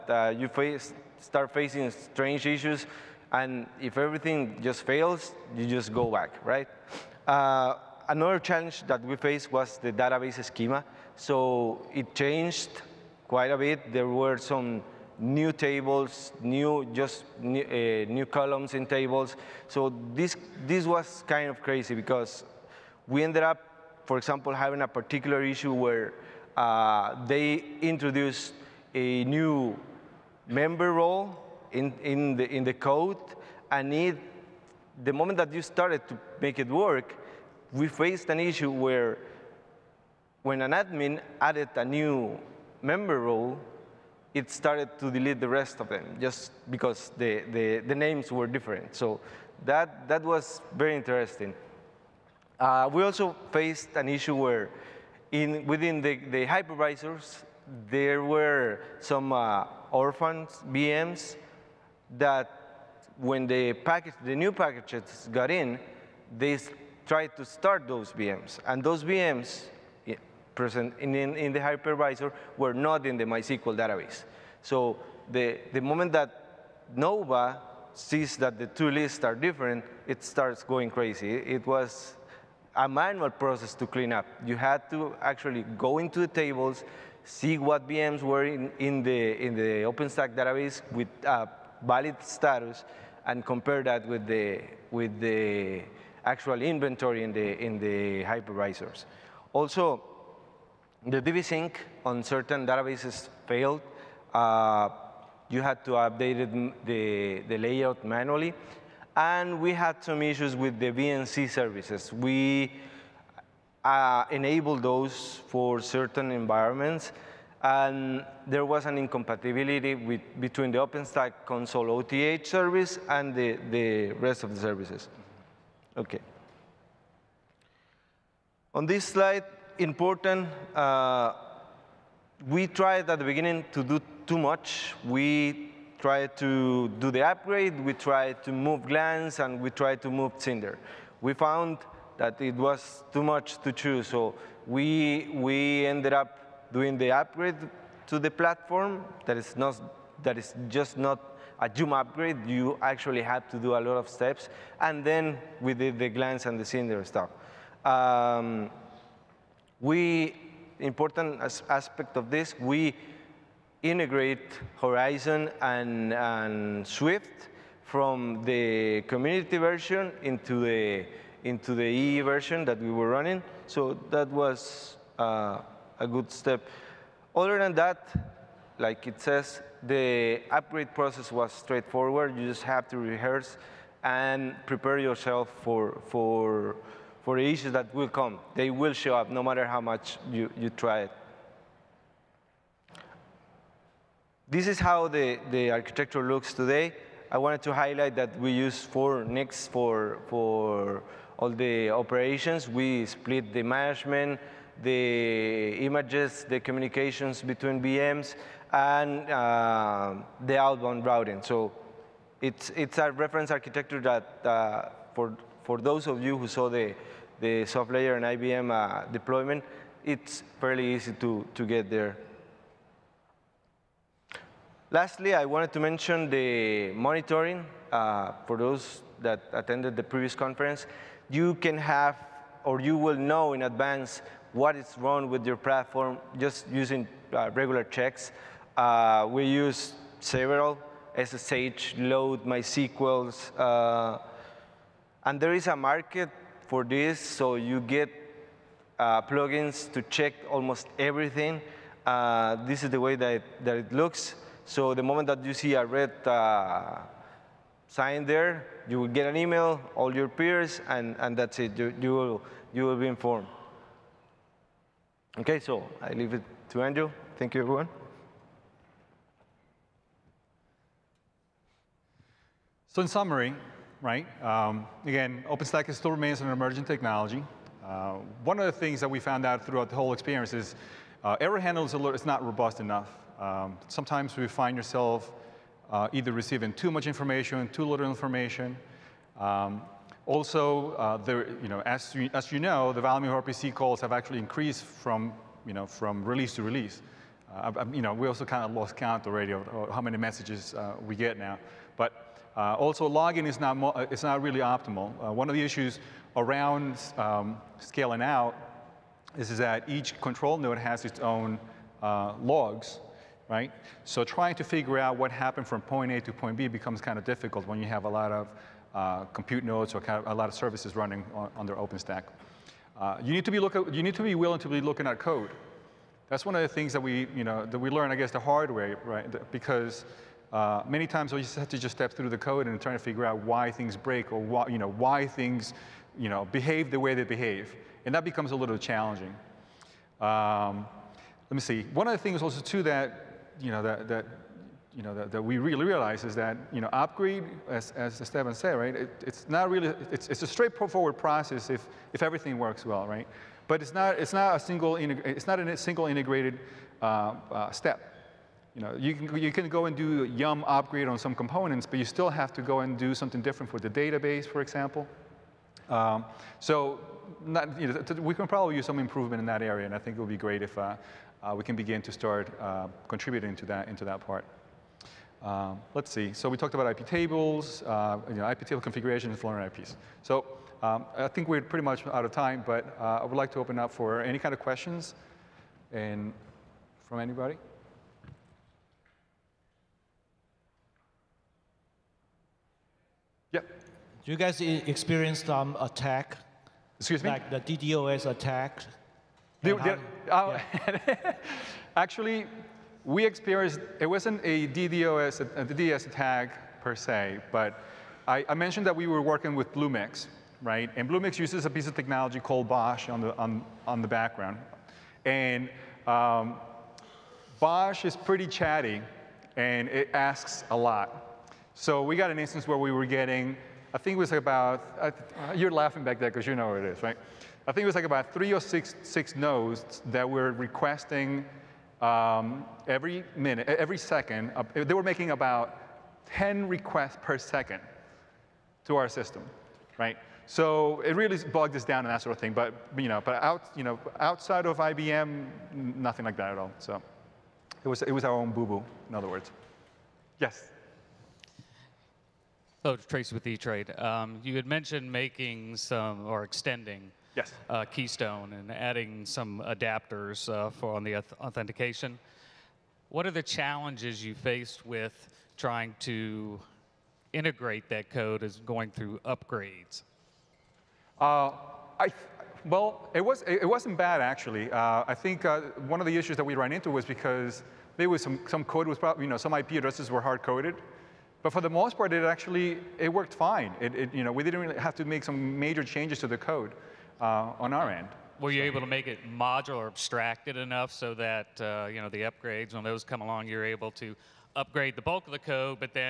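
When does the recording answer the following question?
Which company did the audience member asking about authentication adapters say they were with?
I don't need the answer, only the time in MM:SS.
07:33.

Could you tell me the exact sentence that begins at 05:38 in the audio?
And that becomes a little challenging.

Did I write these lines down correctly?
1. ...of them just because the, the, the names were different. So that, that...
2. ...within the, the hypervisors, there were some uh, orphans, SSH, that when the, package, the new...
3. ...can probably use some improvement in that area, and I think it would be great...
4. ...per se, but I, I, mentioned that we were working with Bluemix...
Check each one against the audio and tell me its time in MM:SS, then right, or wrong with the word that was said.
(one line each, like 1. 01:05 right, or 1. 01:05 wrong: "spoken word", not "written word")
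1. 00:45 right
2. 00:55 wrong: "VMs", not "SSH"
3. 06:08 right
4. 06:46 right.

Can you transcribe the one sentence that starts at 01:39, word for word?
Also, the DBSync on certain databases failed.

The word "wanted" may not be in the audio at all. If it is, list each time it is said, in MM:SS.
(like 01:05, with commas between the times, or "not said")
03:17, 03:45.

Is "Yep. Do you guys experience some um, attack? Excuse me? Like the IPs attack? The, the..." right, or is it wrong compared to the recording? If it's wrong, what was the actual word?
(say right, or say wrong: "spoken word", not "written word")
wrong: "DDoS", not "IPs".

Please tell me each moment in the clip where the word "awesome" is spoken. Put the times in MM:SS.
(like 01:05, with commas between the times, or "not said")
not said.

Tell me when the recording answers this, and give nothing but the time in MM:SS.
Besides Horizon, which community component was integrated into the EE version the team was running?
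02:46.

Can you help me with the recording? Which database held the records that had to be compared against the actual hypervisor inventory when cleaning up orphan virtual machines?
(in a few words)
MySQL.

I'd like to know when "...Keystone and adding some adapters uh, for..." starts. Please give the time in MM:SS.
07:37.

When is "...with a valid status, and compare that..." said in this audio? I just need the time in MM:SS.
01:30.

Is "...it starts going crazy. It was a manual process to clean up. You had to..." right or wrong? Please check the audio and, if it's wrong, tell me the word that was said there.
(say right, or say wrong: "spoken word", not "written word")
right.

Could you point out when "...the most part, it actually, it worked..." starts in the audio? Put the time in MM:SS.
08:01.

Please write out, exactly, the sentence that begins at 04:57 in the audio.
Uh, I, you know, we also kind of lost count already of, of how many messages uh, we get now.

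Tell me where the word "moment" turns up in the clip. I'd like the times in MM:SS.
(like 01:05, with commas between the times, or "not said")
00:35, 01:15, 04:15.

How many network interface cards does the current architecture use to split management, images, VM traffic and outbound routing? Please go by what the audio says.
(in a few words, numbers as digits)
4.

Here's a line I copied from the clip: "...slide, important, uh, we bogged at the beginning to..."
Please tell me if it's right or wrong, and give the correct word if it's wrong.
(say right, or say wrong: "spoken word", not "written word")
wrong: "tried", not "bogged".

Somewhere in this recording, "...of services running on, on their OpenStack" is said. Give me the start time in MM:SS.
05:20.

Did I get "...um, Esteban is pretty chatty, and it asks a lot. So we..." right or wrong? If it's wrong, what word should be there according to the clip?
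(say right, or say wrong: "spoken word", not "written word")
wrong: "BOSH", not "Esteban".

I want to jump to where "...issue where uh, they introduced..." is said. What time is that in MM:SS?
00:25.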